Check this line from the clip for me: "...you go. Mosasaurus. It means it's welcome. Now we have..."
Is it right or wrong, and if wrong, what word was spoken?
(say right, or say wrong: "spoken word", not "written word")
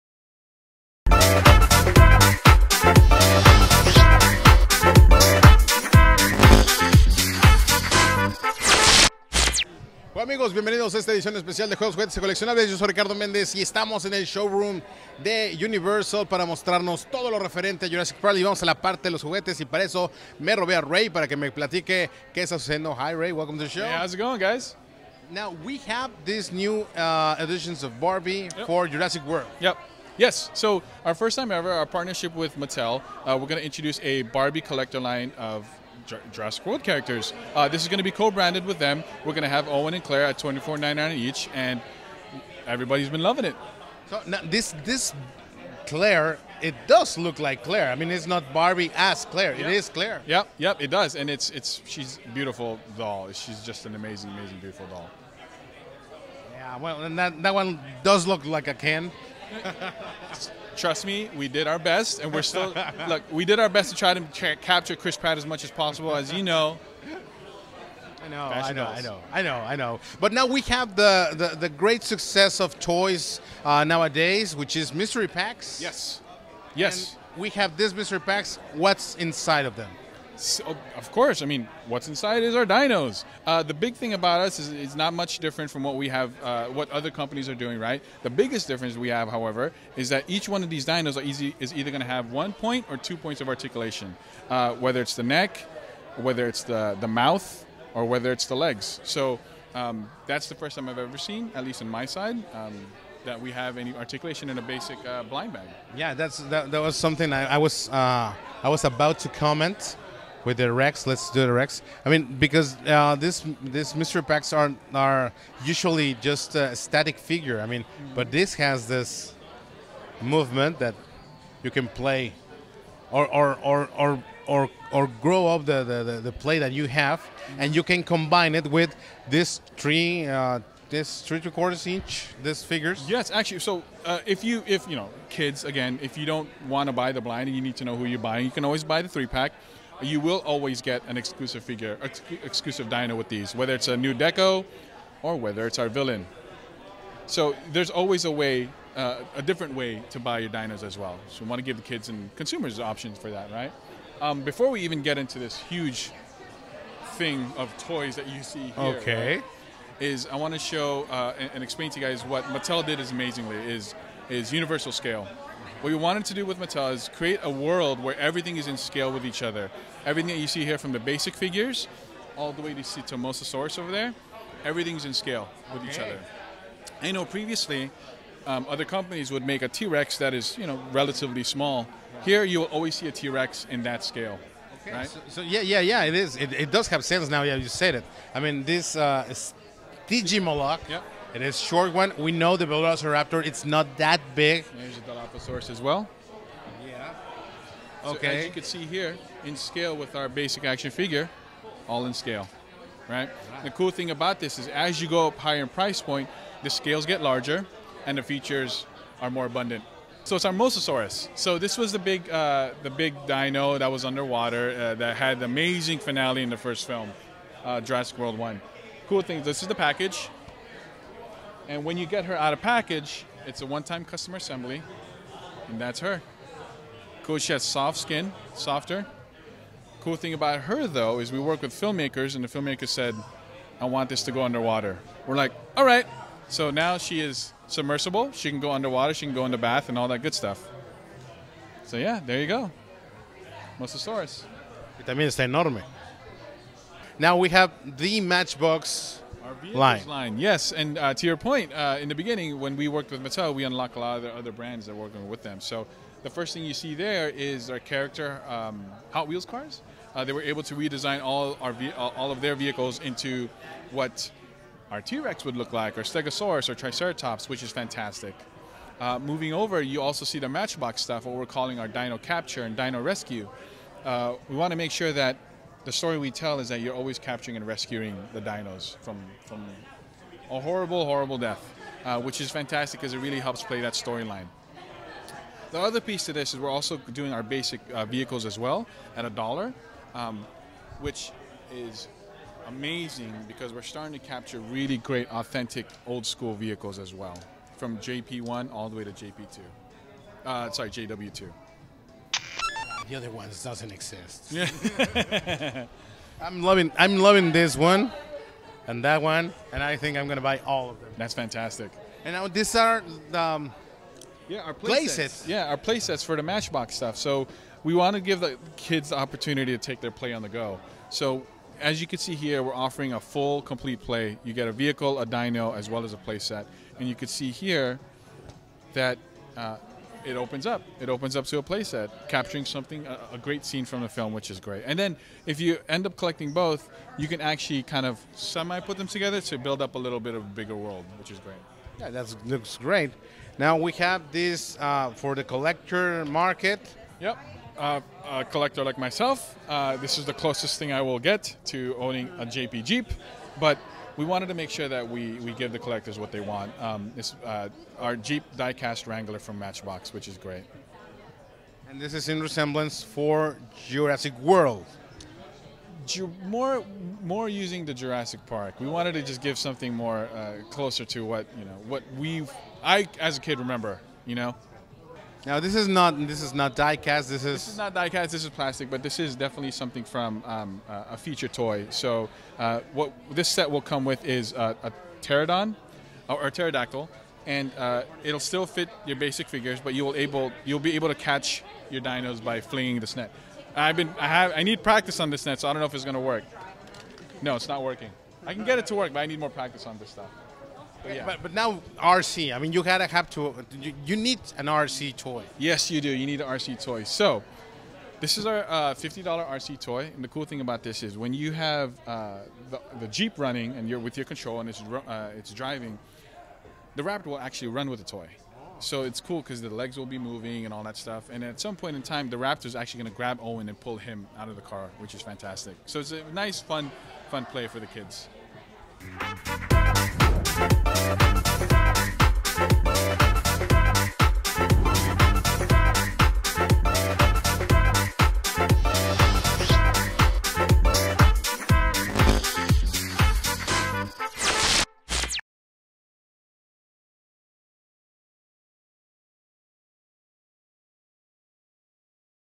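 wrong: "enorme", not "welcome".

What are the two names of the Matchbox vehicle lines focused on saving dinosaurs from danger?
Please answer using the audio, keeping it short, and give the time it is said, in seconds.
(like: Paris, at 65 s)
Dino Capture and Dino Rescue, at 271 s.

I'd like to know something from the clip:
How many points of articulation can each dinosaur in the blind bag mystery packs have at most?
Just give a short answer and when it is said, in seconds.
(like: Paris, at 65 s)
2, at 92 s.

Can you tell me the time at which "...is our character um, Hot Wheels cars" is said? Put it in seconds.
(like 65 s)
257 s.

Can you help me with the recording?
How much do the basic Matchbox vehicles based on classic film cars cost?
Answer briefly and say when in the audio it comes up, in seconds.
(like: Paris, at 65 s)
$1, at 289 s.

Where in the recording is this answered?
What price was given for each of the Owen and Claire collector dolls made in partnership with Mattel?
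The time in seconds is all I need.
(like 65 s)
40 s.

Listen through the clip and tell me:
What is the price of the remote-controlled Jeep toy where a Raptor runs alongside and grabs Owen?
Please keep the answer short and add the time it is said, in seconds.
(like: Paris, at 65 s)
$50, at 408 s.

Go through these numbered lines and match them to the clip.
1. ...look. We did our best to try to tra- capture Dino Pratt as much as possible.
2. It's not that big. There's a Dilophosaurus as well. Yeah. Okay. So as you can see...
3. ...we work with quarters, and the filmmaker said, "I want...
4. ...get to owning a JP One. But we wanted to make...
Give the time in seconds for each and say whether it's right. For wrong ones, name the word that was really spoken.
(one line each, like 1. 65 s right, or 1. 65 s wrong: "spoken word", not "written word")
1. 63 s wrong: "Chris", not "Dino"
2. 193 s right
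3. 231 s wrong: "filmmakers", not "quarters"
4. 351 s wrong: "Jeep", not "One".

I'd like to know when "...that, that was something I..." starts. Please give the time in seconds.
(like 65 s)
106 s.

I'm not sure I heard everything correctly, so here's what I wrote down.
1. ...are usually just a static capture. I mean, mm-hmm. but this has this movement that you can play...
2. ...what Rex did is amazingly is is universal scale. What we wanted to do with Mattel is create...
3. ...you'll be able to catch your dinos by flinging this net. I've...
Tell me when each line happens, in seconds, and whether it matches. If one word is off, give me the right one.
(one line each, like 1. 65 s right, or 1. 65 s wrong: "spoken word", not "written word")
1. 114 s wrong: "figure", not "capture"
2. 162 s wrong: "Mattel", not "Rex"
3. 390 s right.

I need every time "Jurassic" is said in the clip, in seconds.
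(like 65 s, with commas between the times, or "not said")
17 s, 28 s, 36 s, 217 s, 363 s, 367 s.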